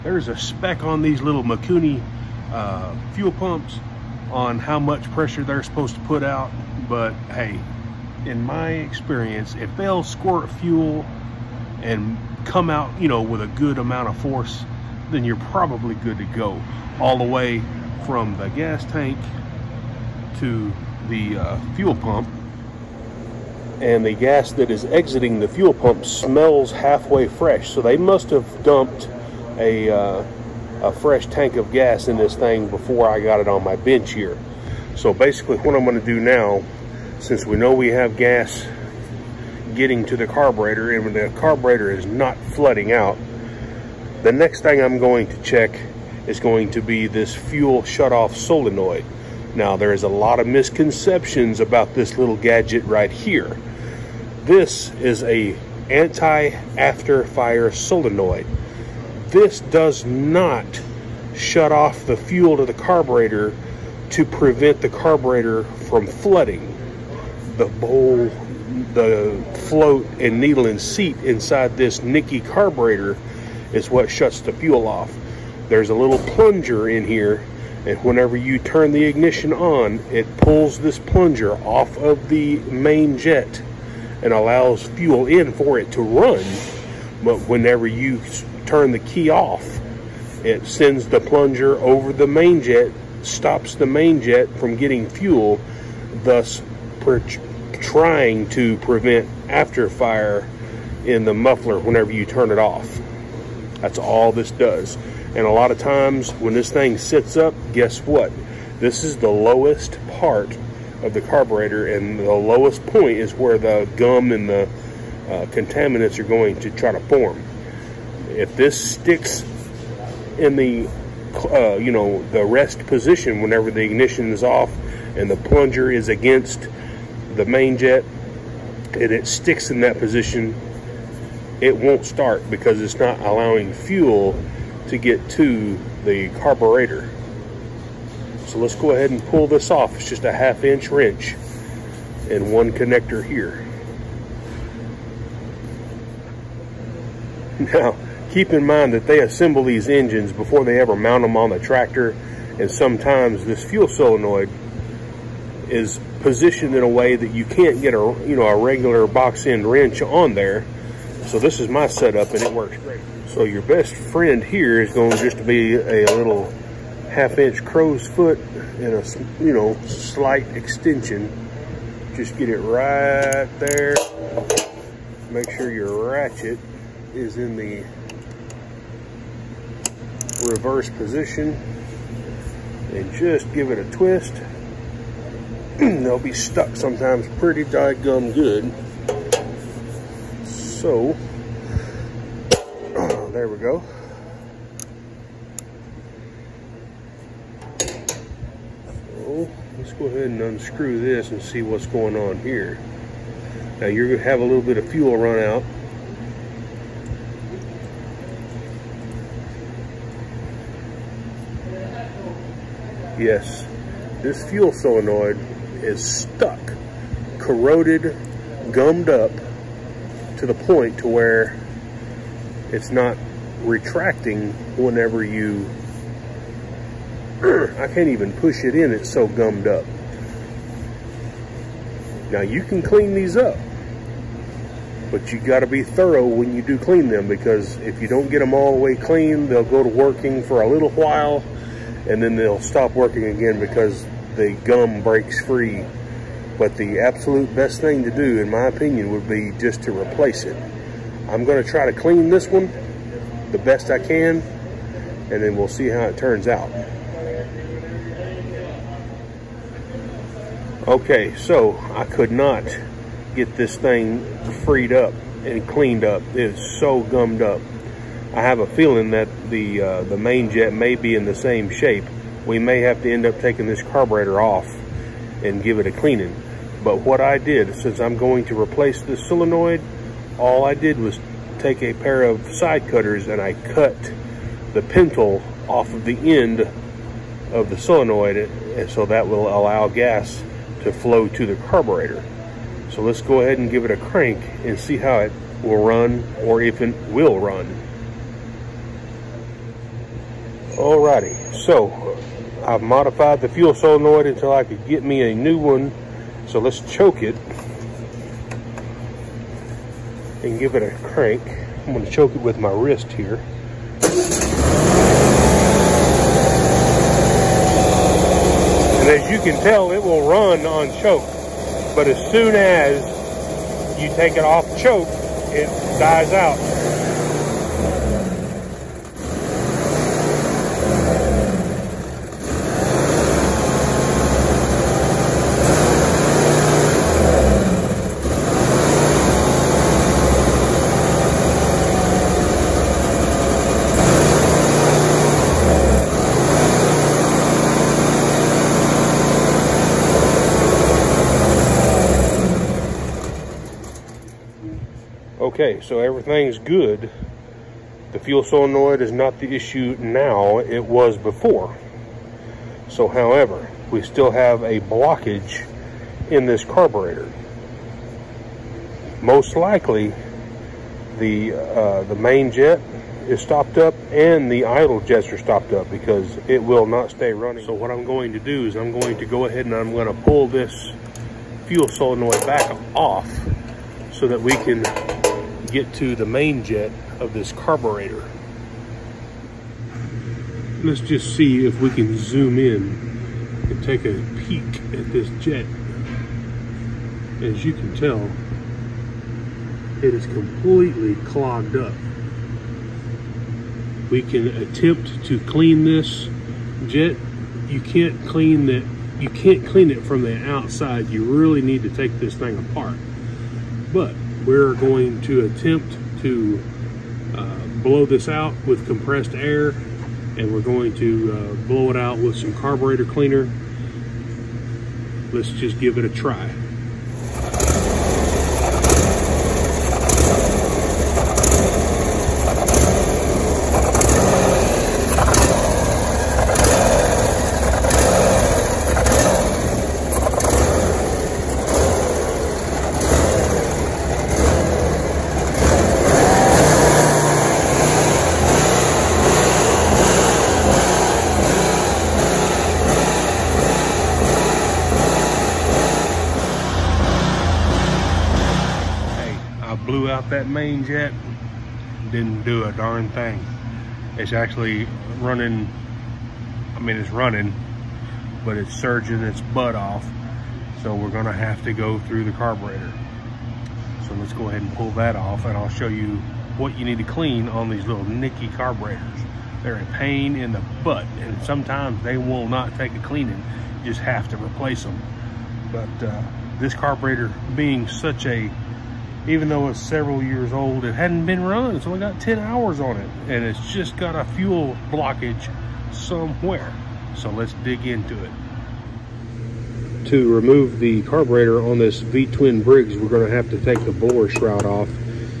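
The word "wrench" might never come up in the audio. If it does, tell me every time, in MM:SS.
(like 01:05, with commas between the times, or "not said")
02:20, 02:39.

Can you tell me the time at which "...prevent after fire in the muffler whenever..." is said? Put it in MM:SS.
01:38.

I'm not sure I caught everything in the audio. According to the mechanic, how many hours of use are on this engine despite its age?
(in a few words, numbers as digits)
10.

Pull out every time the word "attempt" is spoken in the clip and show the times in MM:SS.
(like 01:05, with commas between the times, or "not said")
06:44, 06:55.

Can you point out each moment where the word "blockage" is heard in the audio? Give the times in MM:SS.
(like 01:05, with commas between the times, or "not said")
06:04, 08:14.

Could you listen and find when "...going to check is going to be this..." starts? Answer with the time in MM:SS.
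00:44.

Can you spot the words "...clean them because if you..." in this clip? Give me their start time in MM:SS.
03:56.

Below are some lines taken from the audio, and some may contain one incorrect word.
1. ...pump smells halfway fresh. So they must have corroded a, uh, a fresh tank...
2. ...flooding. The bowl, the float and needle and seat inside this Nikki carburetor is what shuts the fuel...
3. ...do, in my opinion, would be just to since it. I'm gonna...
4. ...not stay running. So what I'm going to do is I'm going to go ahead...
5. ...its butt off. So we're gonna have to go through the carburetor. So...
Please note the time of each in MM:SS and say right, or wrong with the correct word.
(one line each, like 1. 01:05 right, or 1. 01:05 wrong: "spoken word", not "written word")
1. 00:25 wrong: "dumped", not "corroded"
2. 01:06 right
3. 04:08 wrong: "replace", not "since"
4. 06:16 right
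5. 07:49 right.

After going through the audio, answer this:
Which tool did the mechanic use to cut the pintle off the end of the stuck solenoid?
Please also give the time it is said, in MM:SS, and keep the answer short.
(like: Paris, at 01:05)
side cutters, at 04:42.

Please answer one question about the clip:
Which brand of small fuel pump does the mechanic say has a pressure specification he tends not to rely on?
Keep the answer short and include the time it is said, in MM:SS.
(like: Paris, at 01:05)
Mikuni, at 00:01.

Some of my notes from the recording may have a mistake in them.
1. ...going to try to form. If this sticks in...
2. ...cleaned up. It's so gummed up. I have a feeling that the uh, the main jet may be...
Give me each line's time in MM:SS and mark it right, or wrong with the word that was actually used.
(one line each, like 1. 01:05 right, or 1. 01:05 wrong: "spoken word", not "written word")
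1. 01:56 right
2. 04:25 right.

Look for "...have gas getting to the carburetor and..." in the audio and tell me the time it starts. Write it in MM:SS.
00:37.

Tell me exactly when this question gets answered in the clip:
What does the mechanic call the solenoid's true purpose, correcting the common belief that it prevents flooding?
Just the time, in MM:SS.
00:55.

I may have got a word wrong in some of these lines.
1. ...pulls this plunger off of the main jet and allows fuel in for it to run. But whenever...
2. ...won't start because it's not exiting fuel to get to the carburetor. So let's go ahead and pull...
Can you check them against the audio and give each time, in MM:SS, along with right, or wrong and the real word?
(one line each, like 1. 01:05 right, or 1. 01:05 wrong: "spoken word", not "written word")
1. 01:20 right
2. 02:11 wrong: "allowing", not "exiting".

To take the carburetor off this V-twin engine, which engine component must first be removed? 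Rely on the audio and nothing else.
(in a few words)
blower shroud.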